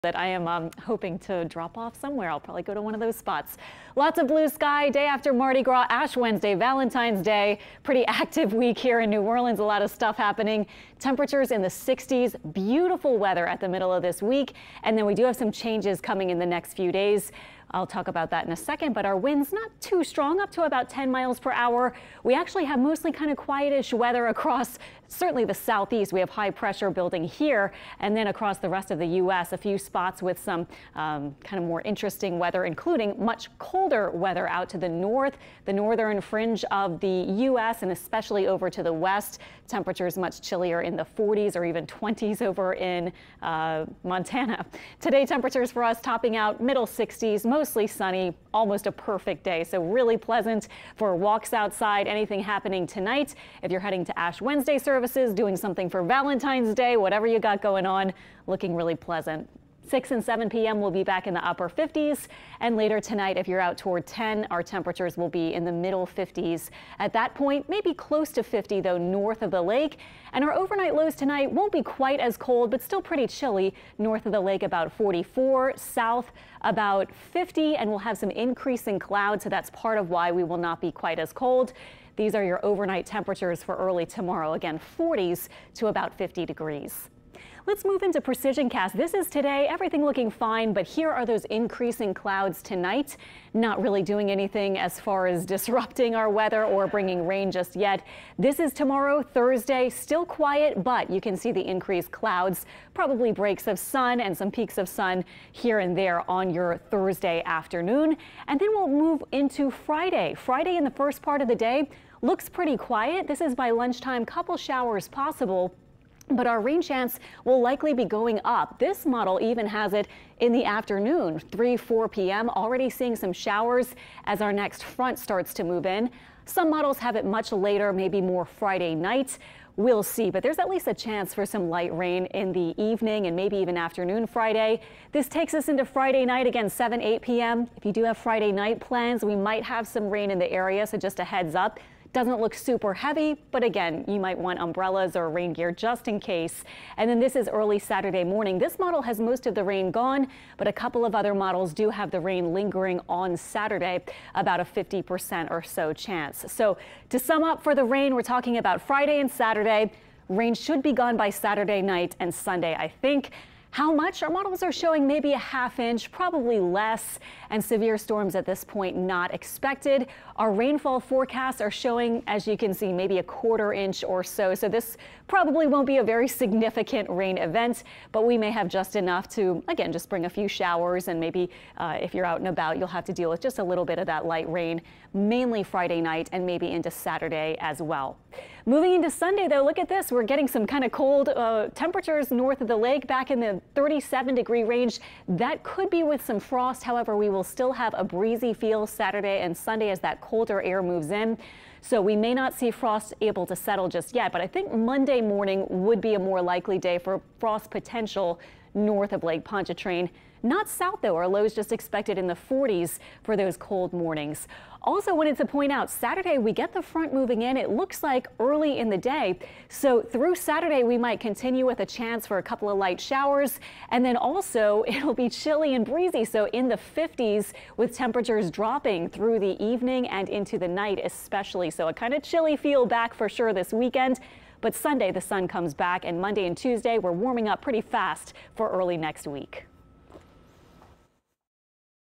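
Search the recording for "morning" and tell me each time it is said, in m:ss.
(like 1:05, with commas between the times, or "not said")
2:28, 3:25, 3:33.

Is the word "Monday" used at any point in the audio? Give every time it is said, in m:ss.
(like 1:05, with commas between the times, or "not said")
3:24, 3:56.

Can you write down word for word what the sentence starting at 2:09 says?
We'll see, but there's at least a chance for some light rain in the evening and maybe even afternoon Friday.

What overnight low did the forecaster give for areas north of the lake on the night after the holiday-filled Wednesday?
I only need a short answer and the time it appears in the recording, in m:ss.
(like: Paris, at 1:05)
44, at 1:14.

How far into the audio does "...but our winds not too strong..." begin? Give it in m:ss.
0:18.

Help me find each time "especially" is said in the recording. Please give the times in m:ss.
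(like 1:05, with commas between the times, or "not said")
0:37, 3:51.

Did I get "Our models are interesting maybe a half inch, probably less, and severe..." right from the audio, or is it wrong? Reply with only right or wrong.
wrong.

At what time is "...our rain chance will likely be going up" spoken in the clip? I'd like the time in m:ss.
1:56.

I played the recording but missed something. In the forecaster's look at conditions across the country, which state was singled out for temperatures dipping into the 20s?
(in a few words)
Montana.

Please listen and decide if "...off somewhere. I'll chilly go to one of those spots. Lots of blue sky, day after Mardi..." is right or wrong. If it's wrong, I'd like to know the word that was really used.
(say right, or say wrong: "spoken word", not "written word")
wrong: "probably", not "chilly".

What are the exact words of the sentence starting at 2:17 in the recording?
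If you do have Friday night plans, we might have some rain in the area, so just a heads up.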